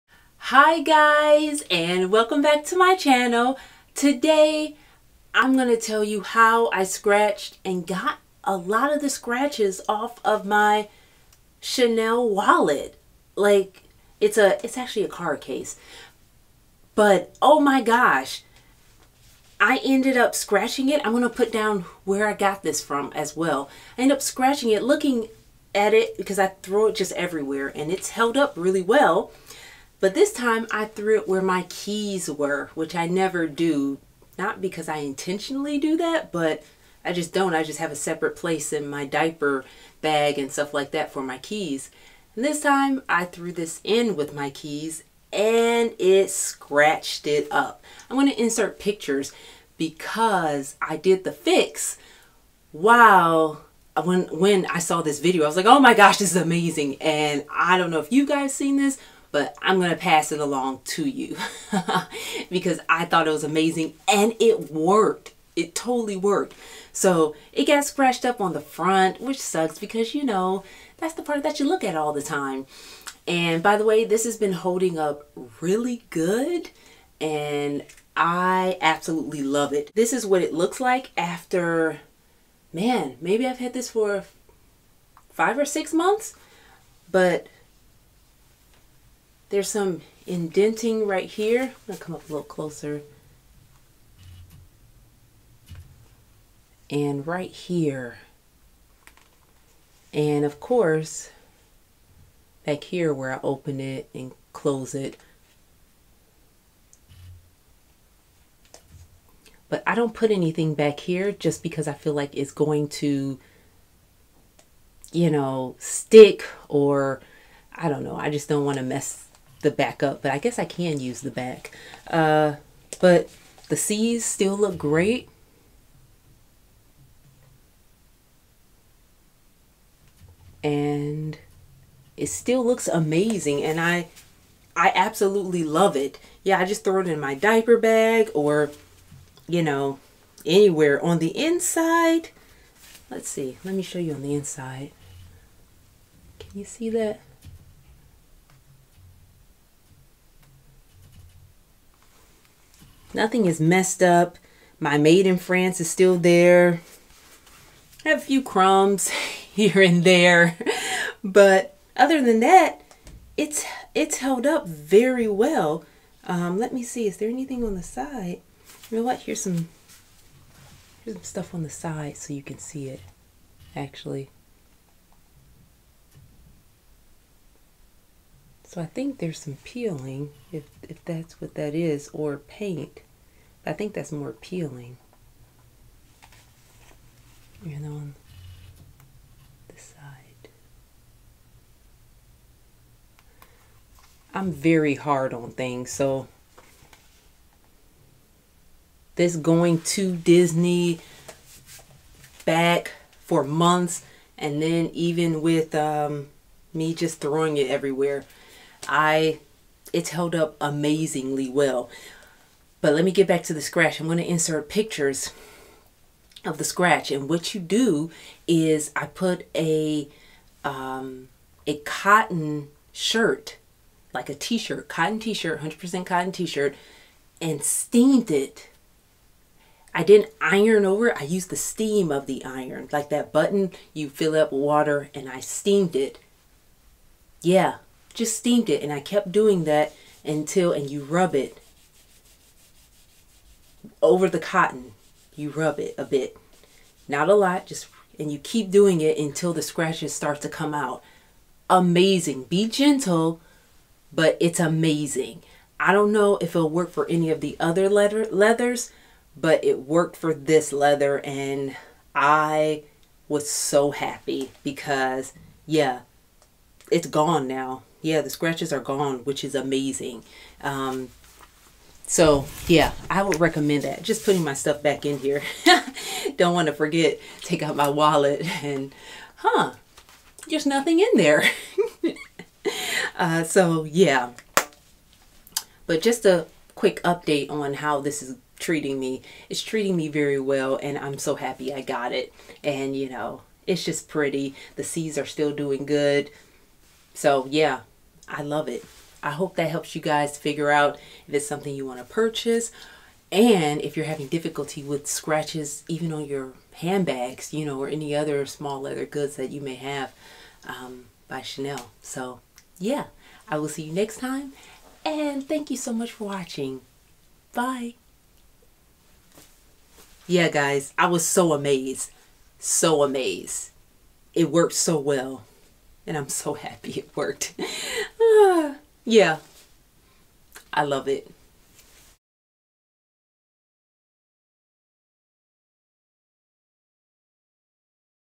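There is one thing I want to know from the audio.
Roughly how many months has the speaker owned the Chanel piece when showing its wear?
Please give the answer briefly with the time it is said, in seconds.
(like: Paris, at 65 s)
5 or 6 months, at 85 s.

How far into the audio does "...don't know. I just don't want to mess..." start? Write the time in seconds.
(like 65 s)
117 s.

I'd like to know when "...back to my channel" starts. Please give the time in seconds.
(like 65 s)
2 s.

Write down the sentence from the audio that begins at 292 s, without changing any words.
And you know, it's just pretty.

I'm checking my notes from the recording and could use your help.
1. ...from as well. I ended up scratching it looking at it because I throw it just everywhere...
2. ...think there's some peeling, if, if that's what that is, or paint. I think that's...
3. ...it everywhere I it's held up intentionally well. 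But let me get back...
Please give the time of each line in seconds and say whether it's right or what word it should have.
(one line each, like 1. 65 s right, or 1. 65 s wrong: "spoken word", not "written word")
1. 22 s right
2. 178 s right
3. 207 s wrong: "amazingly", not "intentionally".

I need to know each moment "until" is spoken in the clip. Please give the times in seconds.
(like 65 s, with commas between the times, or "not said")
240 s, 249 s.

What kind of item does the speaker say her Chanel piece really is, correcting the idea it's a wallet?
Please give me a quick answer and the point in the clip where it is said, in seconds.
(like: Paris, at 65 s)
card case, at 15 s.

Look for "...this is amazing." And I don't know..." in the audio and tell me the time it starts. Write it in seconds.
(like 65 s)
56 s.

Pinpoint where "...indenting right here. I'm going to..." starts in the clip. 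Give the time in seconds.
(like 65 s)
90 s.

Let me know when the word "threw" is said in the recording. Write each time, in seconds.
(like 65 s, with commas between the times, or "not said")
30 s, 43 s.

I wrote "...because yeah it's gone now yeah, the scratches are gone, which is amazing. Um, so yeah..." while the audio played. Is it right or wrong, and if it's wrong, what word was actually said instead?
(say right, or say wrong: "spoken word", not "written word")
right.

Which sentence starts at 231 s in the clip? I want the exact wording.
I used the steam of the iron.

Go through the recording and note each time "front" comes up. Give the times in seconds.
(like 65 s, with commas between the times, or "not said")
68 s.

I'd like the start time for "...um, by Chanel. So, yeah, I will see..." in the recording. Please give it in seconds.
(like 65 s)
310 s.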